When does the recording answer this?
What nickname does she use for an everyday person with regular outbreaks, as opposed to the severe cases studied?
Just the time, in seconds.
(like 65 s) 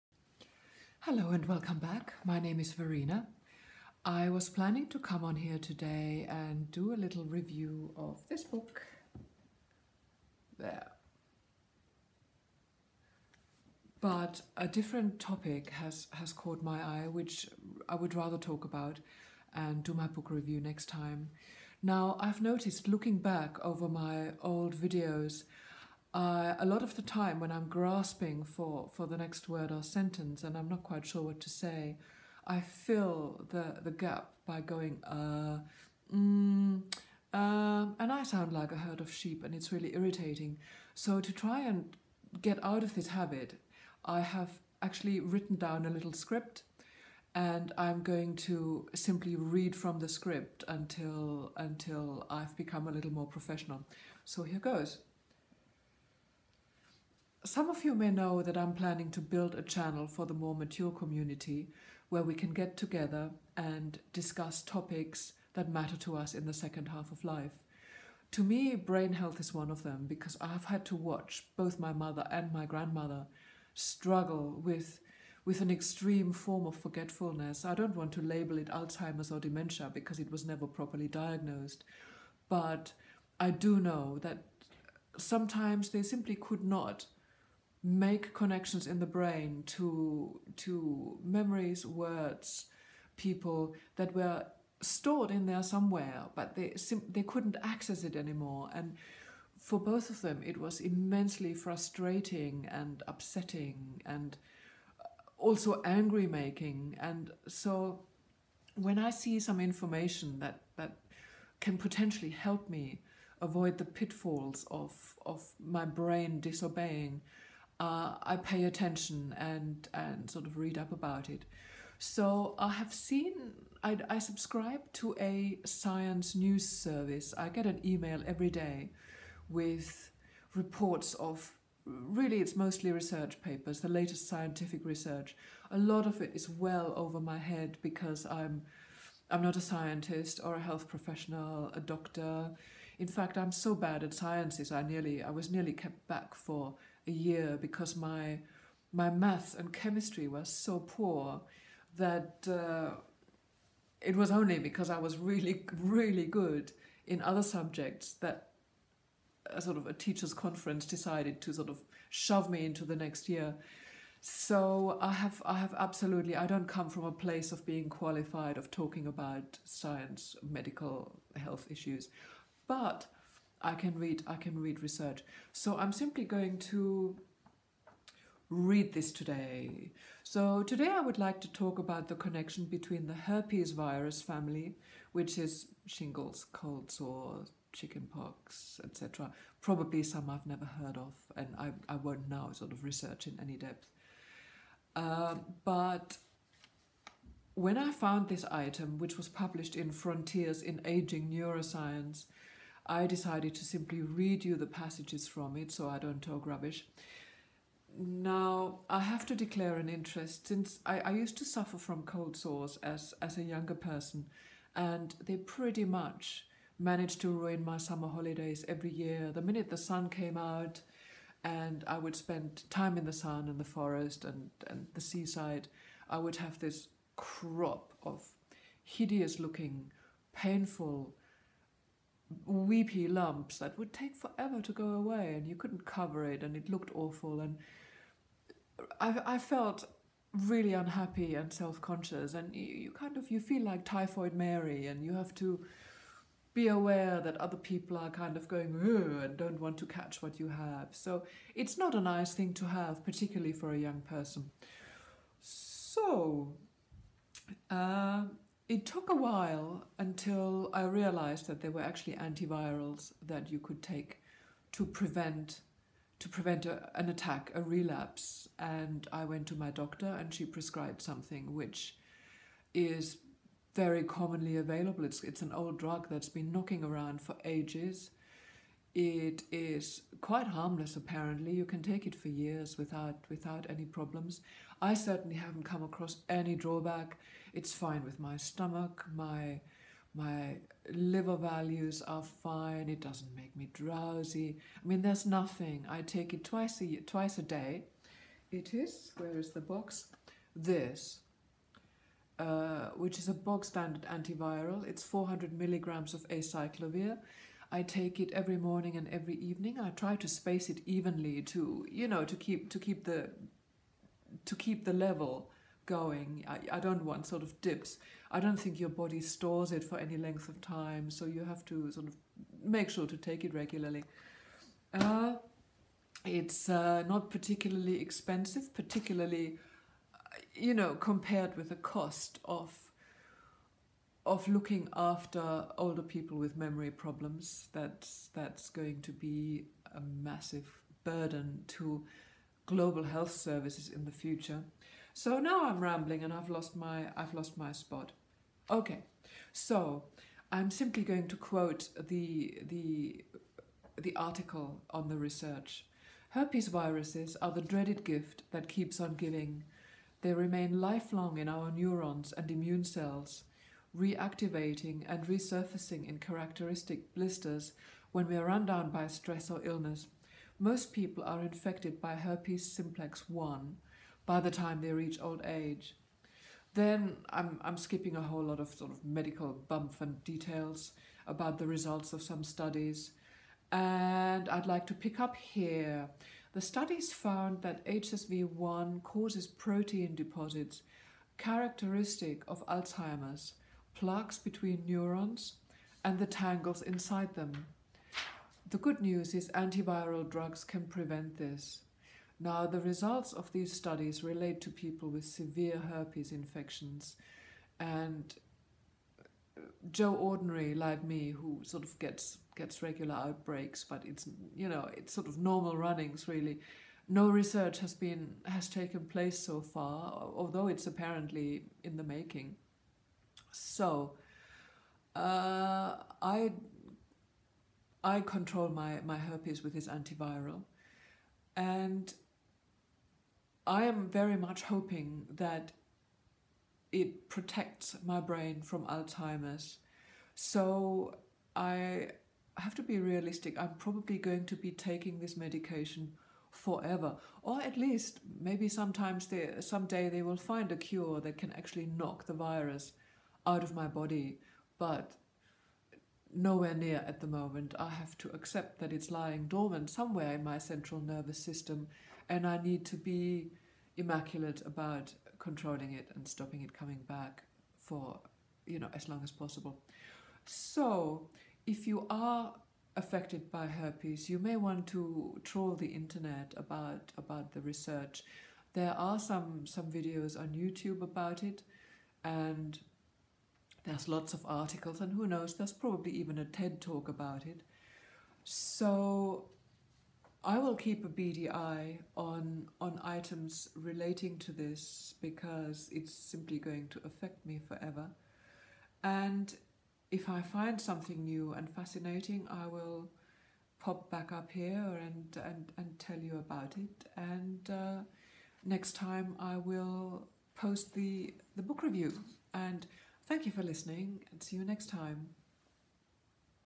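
409 s.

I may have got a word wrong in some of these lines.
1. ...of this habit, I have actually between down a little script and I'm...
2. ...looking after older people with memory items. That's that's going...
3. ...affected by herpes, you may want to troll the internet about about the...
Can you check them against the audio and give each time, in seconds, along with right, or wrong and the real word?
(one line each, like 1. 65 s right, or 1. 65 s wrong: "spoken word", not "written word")
1. 42 s wrong: "written", not "between"
2. 334 s wrong: "problems", not "items"
3. 472 s right.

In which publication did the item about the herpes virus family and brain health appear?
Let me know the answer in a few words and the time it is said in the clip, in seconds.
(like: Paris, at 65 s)
Frontiers in Aging Neuroscience, at 199 s.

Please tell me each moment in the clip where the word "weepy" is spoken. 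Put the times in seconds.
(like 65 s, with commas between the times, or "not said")
232 s.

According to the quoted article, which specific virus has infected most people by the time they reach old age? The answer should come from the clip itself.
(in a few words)
herpes simplex 1.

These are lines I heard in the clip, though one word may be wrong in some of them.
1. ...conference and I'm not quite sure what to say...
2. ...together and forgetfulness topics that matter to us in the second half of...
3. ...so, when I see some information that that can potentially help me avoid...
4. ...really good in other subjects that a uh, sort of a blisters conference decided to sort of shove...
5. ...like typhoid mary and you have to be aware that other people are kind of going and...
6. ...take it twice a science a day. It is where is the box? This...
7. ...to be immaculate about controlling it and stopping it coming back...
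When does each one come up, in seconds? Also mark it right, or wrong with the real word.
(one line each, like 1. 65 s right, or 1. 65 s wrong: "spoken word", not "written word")
1. 29 s wrong: "sentence", not "conference"
2. 62 s wrong: "discuss", not "forgetfulness"
3. 107 s right
4. 155 s wrong: "teachers", not "blisters"
5. 243 s right
6. 296 s wrong: "twice", not "science"
7. 462 s right.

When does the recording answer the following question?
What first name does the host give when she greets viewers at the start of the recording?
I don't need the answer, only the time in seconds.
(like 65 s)
2 s.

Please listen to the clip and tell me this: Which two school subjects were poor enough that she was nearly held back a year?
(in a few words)
math and chemistry.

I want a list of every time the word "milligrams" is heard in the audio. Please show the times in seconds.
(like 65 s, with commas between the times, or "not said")
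305 s.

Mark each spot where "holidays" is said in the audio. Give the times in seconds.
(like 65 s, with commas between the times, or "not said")
218 s.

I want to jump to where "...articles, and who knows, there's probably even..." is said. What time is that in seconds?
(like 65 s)
484 s.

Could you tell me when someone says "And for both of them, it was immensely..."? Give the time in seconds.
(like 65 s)
98 s.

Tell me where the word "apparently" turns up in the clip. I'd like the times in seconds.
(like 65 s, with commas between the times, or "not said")
280 s, 420 s.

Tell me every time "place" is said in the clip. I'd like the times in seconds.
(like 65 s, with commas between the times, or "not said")
167 s, 419 s.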